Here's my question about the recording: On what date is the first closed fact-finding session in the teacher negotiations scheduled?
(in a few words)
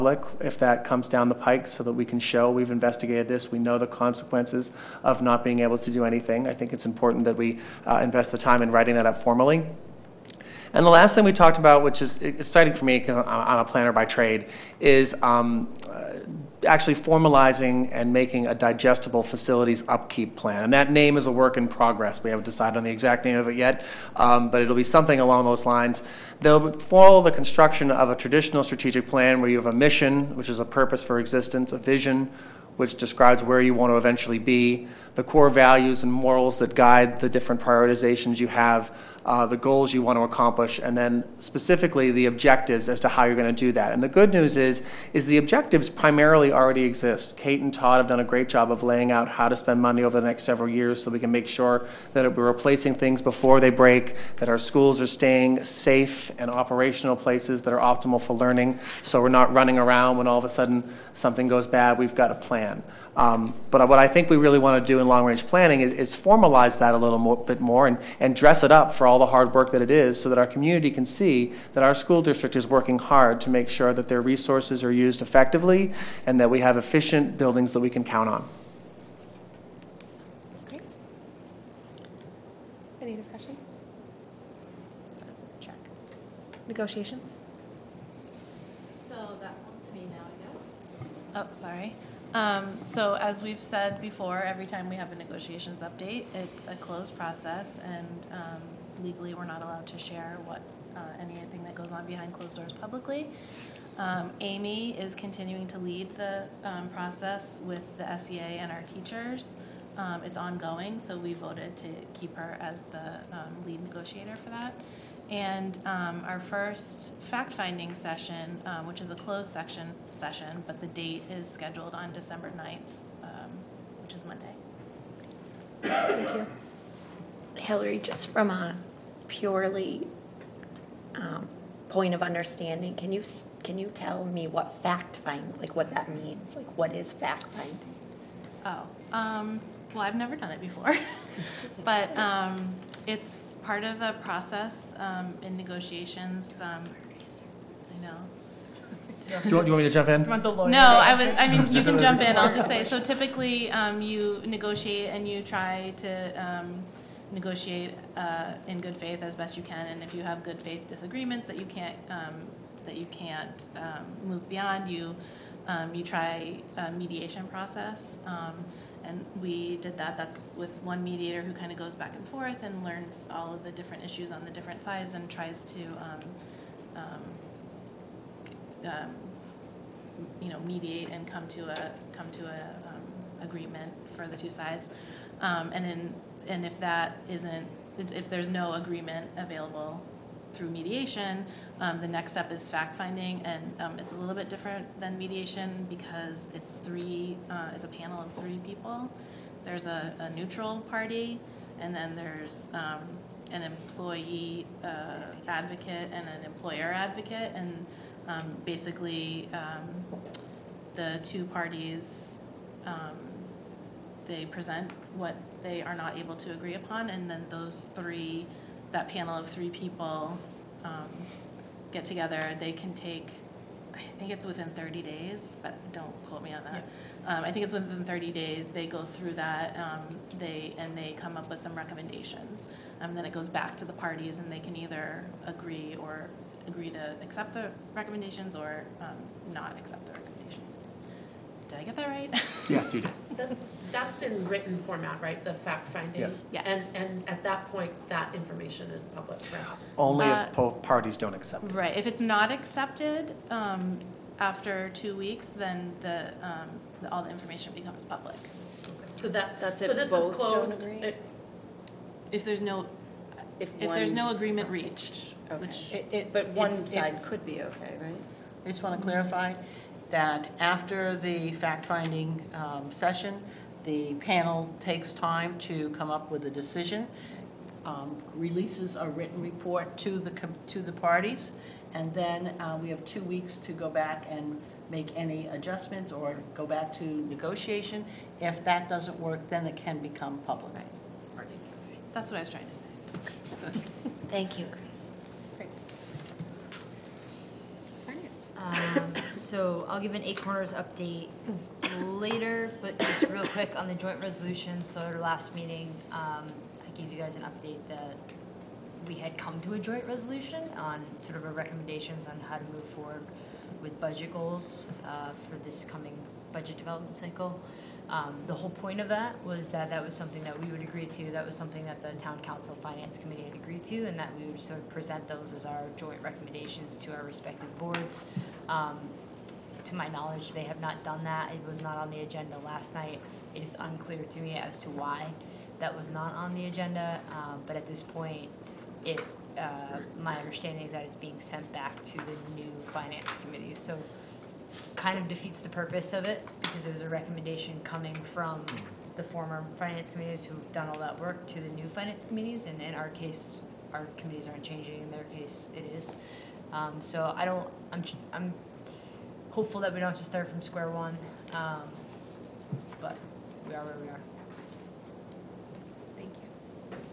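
December 9th.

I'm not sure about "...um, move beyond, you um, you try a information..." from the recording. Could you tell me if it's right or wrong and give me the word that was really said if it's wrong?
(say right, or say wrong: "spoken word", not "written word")
wrong: "mediation", not "information".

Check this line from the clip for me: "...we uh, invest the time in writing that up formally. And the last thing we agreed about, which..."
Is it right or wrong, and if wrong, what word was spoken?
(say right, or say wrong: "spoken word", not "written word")
wrong: "talked", not "agreed".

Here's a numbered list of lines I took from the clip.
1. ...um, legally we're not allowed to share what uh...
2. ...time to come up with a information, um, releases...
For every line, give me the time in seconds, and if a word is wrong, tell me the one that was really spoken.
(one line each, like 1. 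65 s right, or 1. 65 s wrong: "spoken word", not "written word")
1. 98 s right
2. 275 s wrong: "decision", not "information".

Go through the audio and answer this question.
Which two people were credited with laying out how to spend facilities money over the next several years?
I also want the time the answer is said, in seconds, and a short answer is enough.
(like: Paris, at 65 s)
Kate and Todd, at 47 s.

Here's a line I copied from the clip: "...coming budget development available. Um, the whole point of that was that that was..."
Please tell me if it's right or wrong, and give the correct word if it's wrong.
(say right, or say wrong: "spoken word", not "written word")
wrong: "cycle", not "available".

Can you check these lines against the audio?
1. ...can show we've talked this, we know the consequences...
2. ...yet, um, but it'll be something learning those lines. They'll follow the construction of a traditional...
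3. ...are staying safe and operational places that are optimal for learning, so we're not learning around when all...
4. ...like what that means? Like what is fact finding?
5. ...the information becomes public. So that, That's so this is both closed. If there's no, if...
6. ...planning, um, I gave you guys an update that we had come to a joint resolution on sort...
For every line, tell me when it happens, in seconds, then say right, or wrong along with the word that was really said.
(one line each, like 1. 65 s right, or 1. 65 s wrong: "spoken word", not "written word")
1. 2 s wrong: "investigated", not "talked"
2. 23 s wrong: "along", not "learning"
3. 55 s wrong: "running", not "learning"
4. 135 s right
5. 257 s right
6. 305 s wrong: "meeting", not "planning".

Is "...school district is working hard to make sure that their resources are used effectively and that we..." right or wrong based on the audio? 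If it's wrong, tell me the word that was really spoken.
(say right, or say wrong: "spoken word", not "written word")
right.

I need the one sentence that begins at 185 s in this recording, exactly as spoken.
Um, and in, and if that isn't, if there's no agreement available, through mediation.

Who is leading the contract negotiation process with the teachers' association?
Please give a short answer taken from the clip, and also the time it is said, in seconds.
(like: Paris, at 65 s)
Amy, at 104 s.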